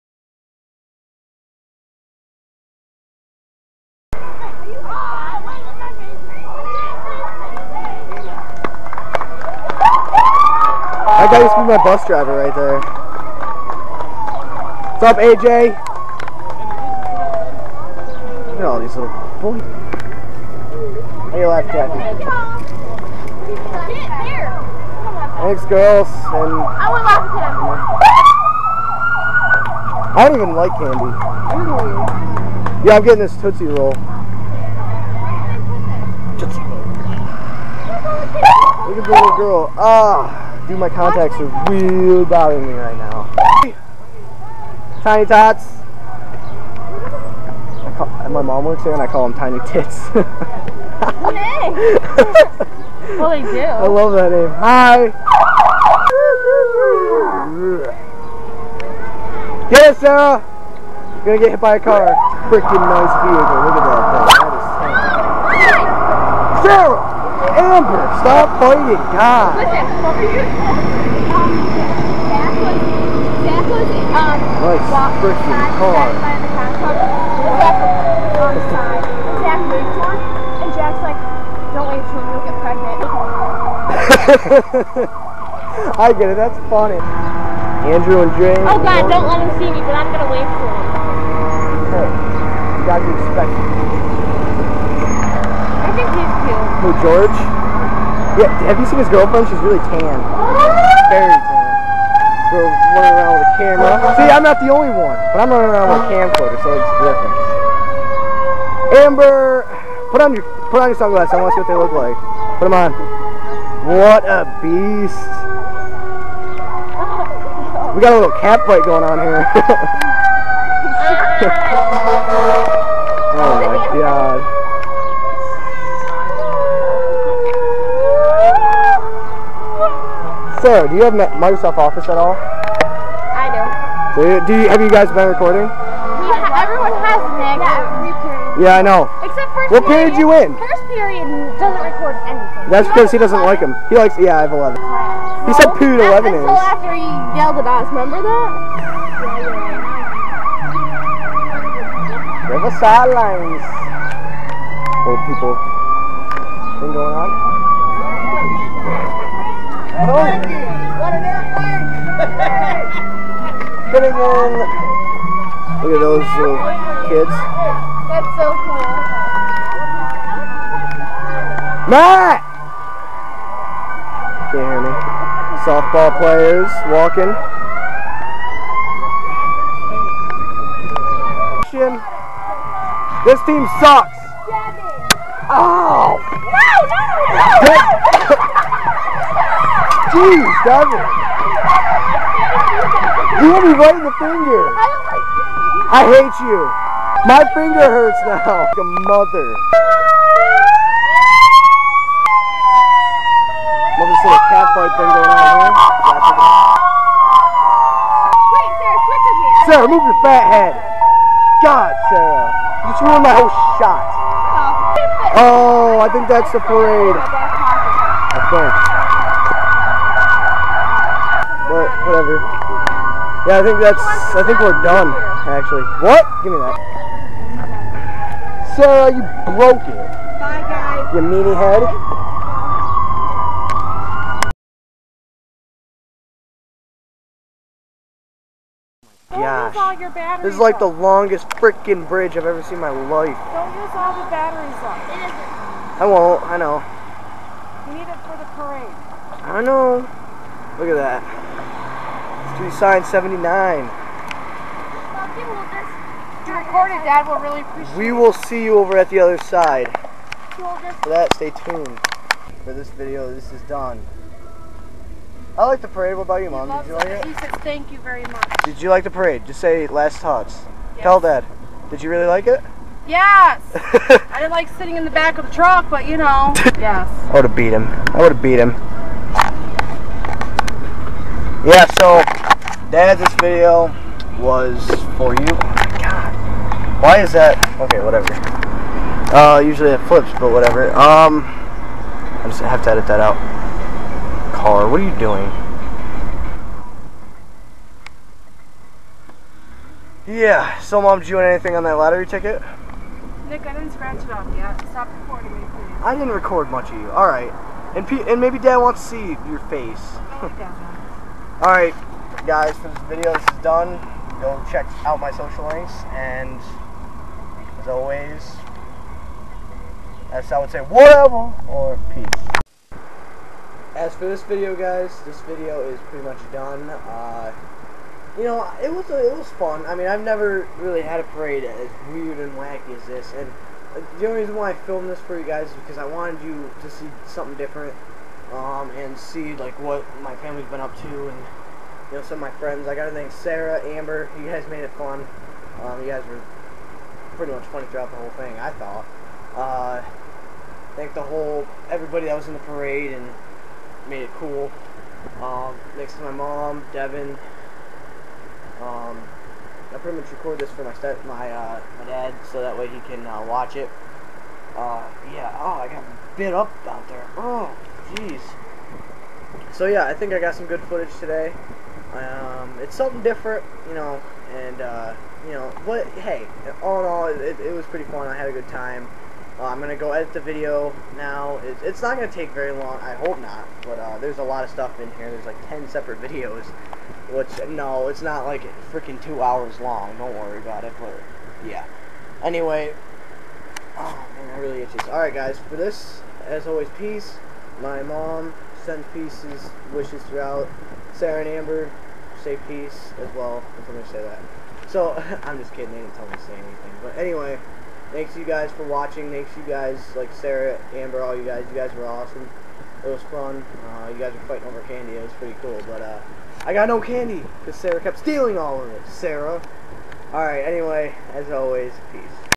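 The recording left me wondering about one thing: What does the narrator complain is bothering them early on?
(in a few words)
contacts.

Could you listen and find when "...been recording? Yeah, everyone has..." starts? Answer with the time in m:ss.
2:15.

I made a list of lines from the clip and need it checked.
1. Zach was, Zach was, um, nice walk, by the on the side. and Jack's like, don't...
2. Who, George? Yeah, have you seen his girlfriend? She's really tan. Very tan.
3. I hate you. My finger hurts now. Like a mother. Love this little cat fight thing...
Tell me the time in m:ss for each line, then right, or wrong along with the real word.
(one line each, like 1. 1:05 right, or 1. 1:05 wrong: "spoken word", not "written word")
1. 1:12 right
2. 1:36 right
3. 3:15 right.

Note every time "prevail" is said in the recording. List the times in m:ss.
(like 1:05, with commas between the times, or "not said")
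not said.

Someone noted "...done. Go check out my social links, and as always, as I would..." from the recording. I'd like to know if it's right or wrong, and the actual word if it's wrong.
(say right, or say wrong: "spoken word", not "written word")
right.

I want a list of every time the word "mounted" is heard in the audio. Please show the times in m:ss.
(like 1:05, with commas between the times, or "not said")
not said.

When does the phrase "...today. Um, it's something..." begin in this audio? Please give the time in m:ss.
6:11.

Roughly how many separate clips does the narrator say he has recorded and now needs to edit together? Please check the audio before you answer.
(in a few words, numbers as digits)
10.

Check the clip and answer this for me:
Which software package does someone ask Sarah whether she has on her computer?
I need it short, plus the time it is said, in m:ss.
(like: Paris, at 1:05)
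Microsoft Office, at 2:11.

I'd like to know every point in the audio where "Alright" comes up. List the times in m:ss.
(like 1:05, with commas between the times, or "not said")
5:11, 7:00.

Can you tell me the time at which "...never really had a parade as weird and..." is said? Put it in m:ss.
5:30.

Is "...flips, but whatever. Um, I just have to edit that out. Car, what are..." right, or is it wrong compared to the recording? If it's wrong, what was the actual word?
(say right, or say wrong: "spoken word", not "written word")
right.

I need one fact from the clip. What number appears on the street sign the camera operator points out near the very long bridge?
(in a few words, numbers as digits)
79.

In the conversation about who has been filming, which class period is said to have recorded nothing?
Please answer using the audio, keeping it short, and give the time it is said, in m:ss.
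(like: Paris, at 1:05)
First period, at 2:20.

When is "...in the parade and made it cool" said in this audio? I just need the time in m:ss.
5:52.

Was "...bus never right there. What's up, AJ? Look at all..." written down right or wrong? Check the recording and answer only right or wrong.
wrong.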